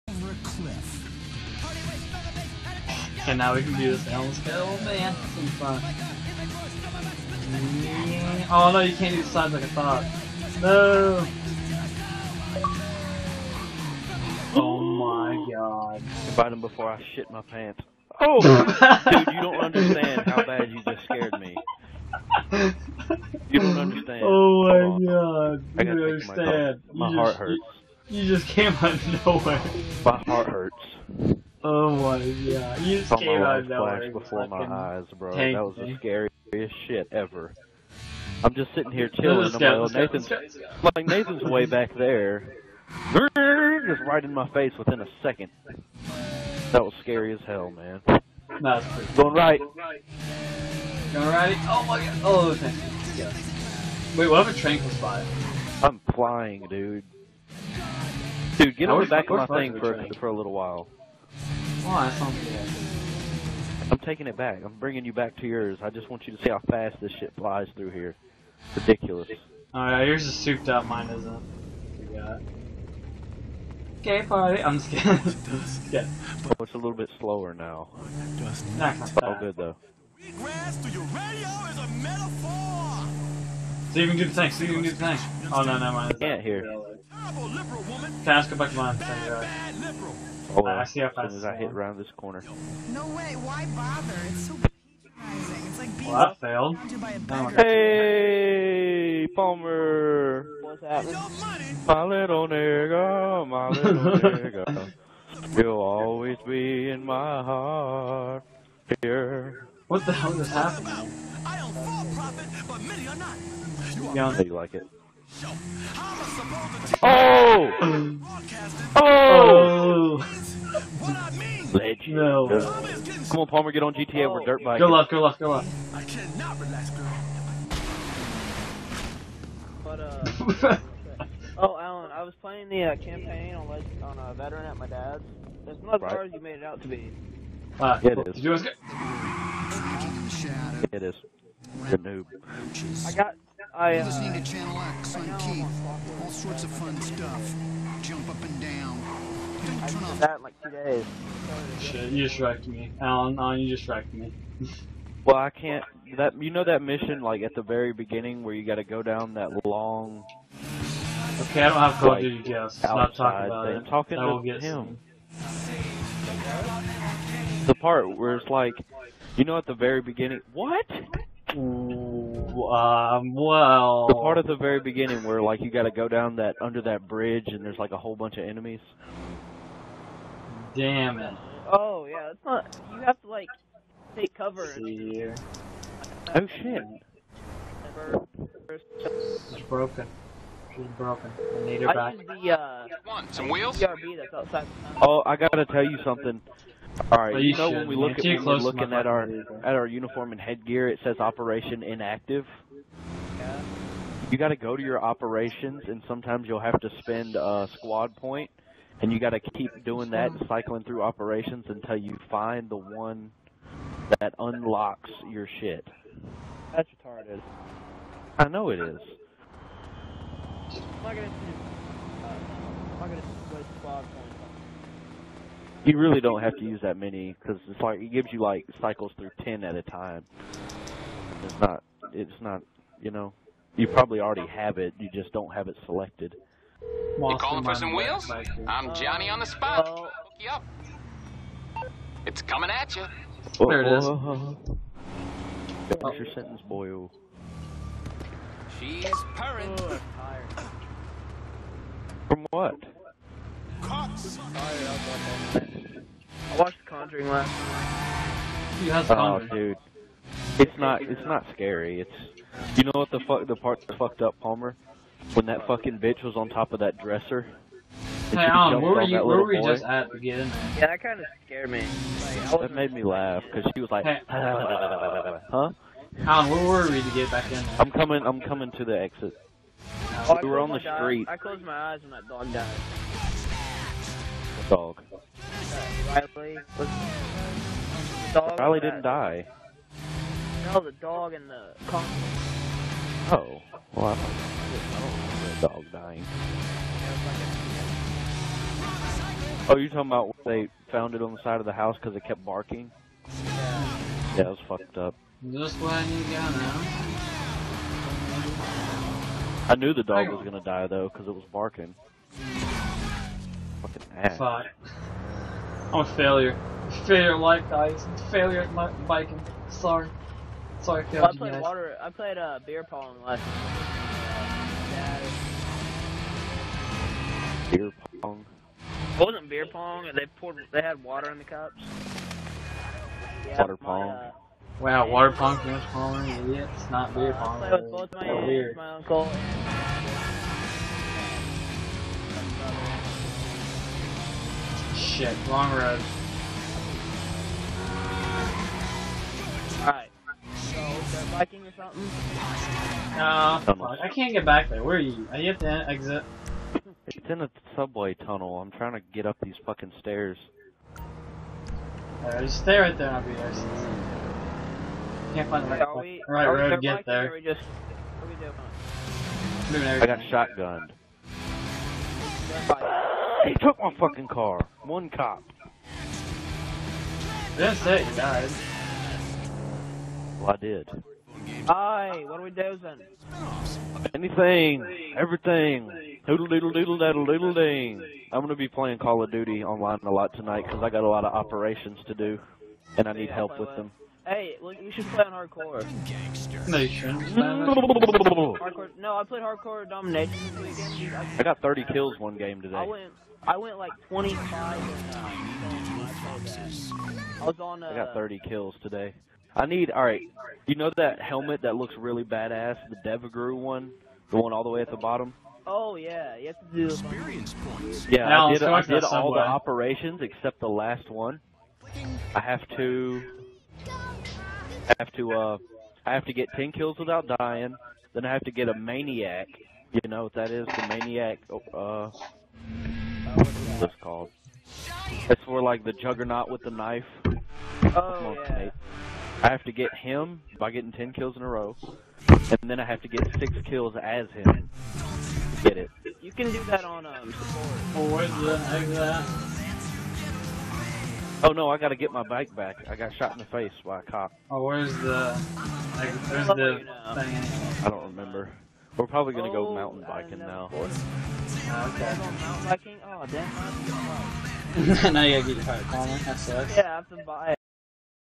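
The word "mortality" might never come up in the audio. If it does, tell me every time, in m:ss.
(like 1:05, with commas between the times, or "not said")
not said.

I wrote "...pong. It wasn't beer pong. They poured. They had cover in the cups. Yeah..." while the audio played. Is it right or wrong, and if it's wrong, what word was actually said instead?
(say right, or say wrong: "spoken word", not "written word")
wrong: "water", not "cover".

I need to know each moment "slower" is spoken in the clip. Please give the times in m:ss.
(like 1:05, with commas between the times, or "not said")
1:17.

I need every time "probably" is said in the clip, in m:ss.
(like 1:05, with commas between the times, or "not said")
3:53, 7:39.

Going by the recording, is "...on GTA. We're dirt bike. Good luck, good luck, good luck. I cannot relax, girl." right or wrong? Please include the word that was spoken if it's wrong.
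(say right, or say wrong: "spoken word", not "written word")
right.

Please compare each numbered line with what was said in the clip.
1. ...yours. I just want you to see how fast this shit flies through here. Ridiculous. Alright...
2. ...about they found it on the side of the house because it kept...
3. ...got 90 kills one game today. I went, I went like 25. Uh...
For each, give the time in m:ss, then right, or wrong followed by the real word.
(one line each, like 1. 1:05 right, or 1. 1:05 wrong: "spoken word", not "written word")
1. 1:05 right
2. 5:00 right
3. 6:41 wrong: "30", not "90".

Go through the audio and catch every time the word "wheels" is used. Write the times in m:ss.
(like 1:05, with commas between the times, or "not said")
3:13, 3:57.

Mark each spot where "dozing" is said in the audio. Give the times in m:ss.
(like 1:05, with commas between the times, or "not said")
6:22.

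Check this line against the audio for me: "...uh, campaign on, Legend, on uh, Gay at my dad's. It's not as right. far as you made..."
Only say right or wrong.
wrong.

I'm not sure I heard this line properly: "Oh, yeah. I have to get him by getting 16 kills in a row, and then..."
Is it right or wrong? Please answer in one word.
wrong.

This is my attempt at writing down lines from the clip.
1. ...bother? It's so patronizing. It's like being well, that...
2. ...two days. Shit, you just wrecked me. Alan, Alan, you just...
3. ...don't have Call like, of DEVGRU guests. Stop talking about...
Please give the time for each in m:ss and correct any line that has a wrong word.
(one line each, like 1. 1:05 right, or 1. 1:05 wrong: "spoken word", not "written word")
1. 1:33 right
2. 2:30 right
3. 2:41 wrong: "Duty", not "DEVGRU".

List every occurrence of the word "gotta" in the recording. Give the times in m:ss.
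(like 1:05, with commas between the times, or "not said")
2:38, 3:15, 7:31, 7:45.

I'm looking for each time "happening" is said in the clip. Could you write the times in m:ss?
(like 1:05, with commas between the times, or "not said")
1:40, 1:50.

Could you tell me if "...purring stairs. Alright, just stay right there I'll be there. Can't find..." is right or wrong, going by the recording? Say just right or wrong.
wrong.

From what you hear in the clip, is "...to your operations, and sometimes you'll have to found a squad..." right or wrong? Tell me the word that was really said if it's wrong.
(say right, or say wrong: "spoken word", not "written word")
wrong: "spend", not "found".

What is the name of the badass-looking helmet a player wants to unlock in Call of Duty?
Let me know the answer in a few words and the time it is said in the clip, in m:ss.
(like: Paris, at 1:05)
DEVGRU, at 6:52.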